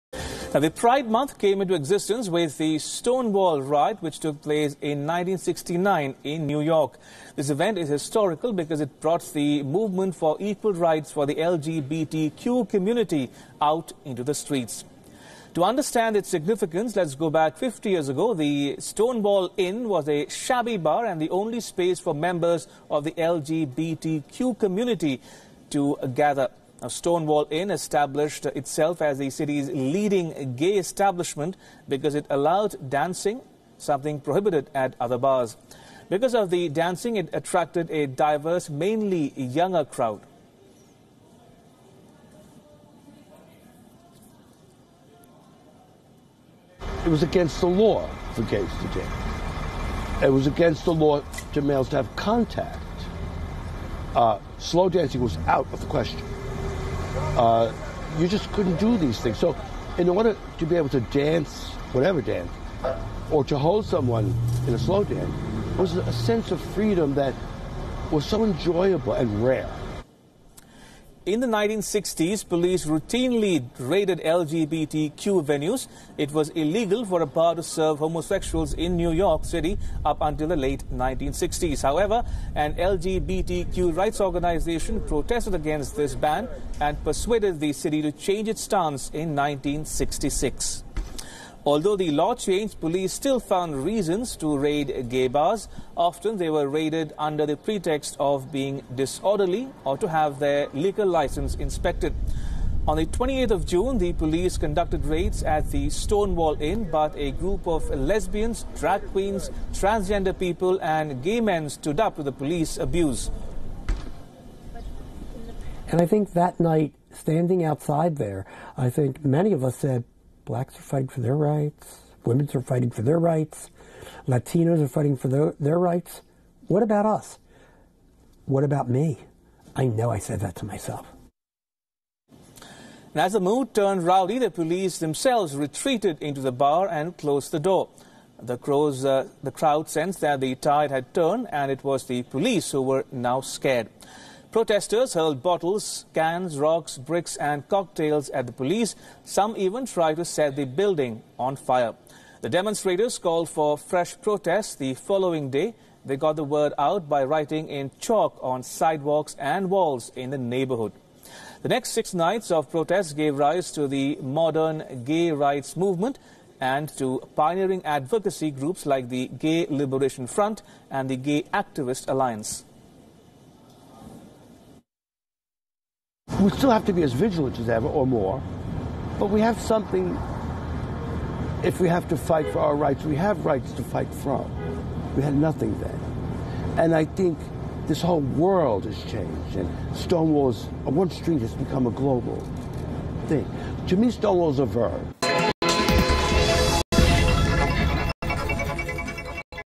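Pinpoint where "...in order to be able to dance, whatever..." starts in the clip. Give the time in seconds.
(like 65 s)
59 s.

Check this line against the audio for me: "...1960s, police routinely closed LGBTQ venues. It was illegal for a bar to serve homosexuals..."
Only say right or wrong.
wrong.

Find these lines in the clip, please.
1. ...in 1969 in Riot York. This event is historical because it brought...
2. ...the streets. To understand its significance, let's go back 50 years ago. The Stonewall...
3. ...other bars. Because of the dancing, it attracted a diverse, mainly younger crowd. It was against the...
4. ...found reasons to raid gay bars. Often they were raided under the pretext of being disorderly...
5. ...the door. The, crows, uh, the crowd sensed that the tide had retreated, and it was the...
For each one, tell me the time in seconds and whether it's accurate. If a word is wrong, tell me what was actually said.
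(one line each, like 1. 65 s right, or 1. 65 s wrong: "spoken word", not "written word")
1. 4 s wrong: "New", not "Riot"
2. 14 s right
3. 34 s right
4. 93 s right
5. 137 s wrong: "turned", not "retreated".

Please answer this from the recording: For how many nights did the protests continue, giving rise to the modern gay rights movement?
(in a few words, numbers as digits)
6.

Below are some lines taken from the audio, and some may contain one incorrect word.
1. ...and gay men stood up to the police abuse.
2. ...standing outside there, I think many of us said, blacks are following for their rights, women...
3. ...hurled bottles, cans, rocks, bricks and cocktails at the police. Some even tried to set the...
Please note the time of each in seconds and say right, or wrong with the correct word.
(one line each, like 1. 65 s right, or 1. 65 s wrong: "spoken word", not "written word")
1. 110 s right
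2. 117 s wrong: "fighting", not "following"
3. 145 s right.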